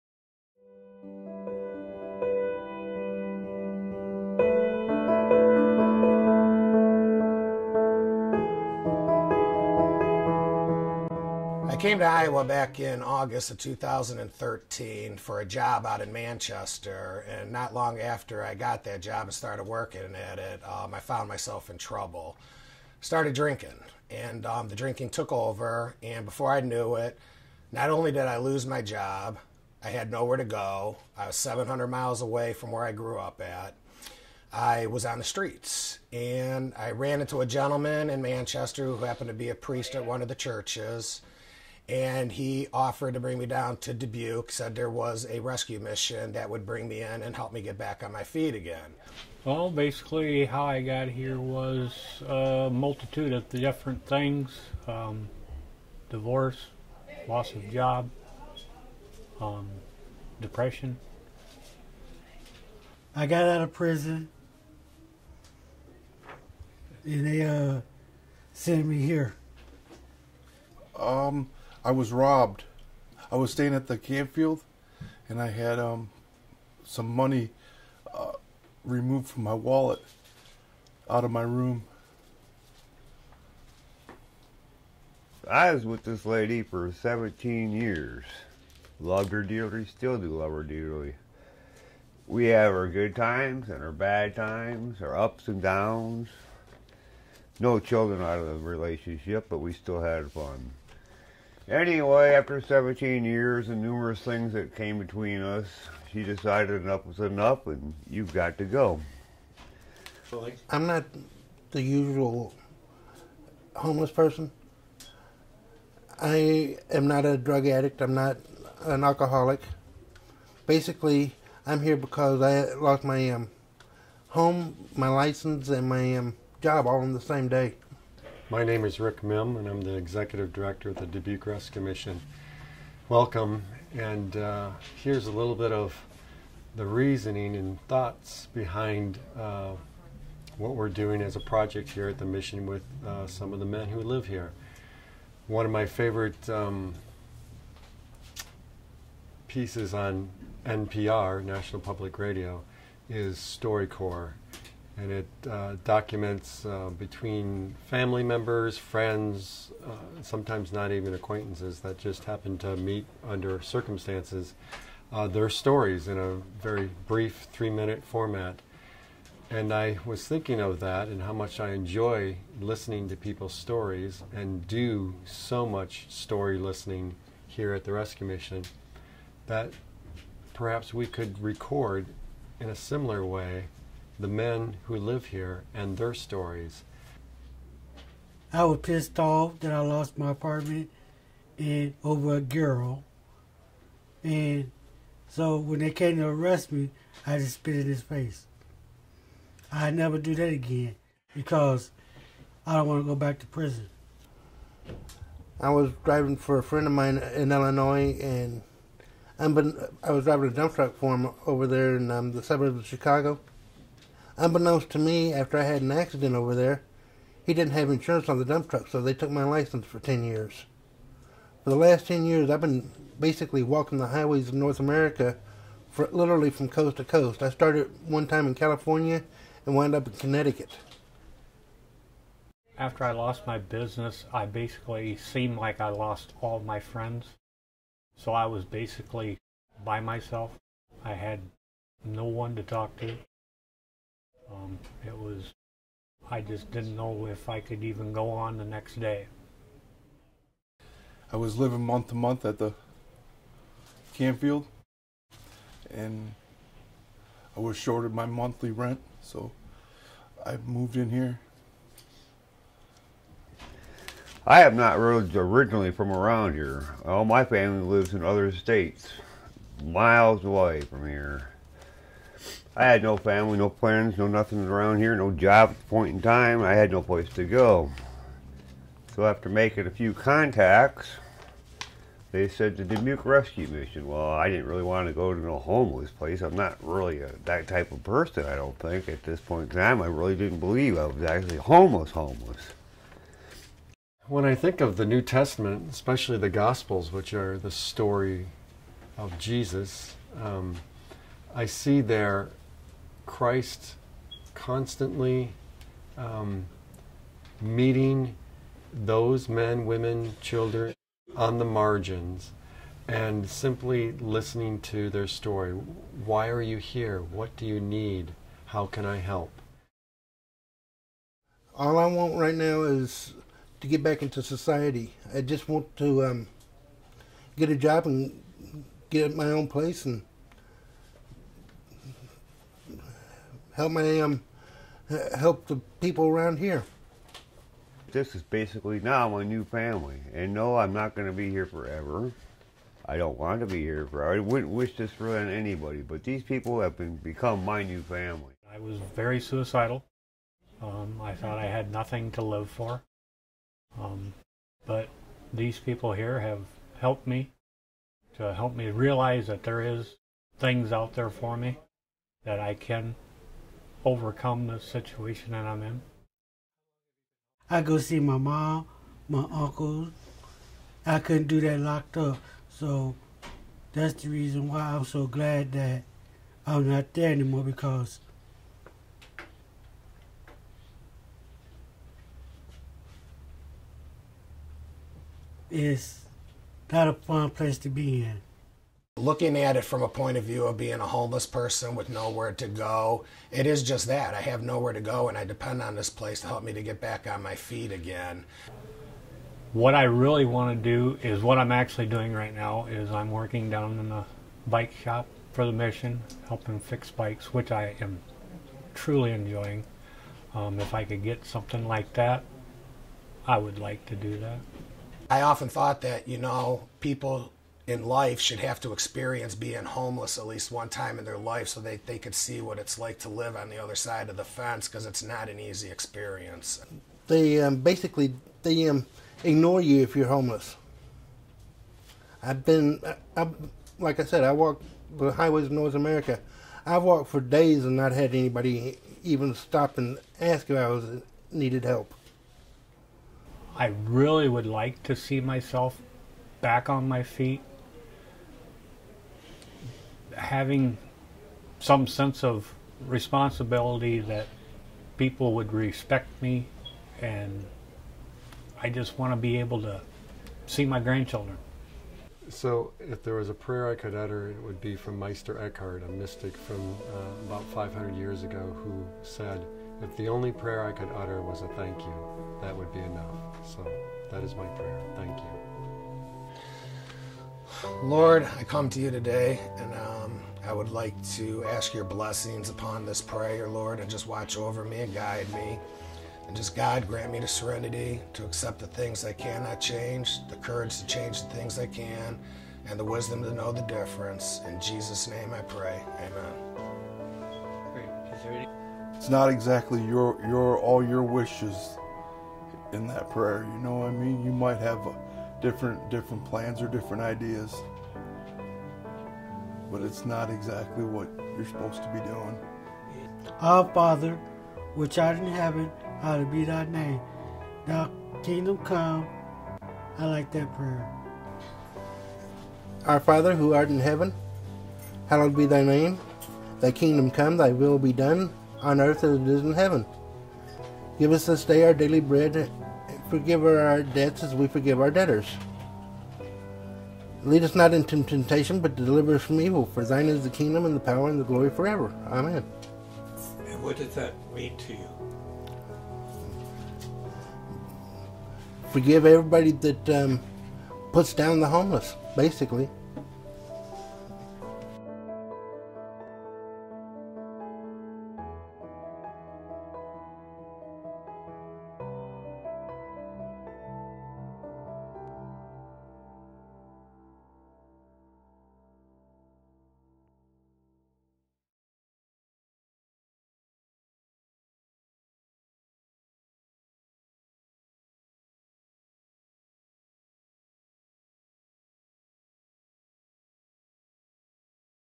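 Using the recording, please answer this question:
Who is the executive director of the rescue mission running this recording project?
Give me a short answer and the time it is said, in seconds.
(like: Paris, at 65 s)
Rick Mihm, at 128 s.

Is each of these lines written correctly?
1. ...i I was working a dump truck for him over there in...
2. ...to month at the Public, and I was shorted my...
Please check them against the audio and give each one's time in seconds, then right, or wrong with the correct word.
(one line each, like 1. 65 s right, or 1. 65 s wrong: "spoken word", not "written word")
1. 209 s wrong: "driving", not "working"
2. 252 s wrong: "Campfield", not "Public".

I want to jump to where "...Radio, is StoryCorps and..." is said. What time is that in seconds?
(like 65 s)
152 s.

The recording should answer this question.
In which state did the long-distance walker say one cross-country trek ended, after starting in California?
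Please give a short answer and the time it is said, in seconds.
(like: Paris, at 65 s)
Connecticut, at 230 s.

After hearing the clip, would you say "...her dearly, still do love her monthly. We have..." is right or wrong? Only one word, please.
wrong.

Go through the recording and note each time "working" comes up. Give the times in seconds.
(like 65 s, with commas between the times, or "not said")
19 s, 403 s.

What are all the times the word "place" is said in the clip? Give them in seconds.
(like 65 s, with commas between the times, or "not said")
277 s, 286 s, 329 s, 387 s, 396 s.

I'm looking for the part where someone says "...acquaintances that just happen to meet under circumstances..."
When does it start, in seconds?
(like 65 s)
161 s.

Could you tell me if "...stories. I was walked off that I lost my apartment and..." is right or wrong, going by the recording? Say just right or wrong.
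wrong.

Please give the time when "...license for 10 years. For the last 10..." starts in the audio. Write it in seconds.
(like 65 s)
219 s.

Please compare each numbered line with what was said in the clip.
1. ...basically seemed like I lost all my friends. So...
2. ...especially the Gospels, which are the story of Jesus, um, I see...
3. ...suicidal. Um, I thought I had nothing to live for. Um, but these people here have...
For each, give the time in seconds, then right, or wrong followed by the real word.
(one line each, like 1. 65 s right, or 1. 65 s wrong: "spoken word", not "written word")
1. 234 s right
2. 295 s right
3. 349 s right.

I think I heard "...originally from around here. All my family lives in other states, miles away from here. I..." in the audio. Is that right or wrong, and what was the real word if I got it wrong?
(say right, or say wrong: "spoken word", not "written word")
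right.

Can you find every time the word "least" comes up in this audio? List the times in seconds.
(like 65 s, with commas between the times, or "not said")
420 s.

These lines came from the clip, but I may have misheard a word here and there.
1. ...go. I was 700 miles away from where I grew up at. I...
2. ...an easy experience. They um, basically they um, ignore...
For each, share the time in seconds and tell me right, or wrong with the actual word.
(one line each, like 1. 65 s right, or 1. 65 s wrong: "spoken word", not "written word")
1. 30 s right
2. 425 s right.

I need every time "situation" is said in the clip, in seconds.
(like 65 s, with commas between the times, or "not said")
364 s.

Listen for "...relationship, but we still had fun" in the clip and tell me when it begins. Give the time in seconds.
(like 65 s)
98 s.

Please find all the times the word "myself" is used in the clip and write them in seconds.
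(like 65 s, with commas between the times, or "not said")
21 s, 239 s, 445 s.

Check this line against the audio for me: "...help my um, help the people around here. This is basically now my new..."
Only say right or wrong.
right.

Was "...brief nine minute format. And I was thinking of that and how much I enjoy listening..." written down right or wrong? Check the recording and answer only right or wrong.
wrong.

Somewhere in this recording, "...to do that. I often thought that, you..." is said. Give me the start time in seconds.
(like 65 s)
414 s.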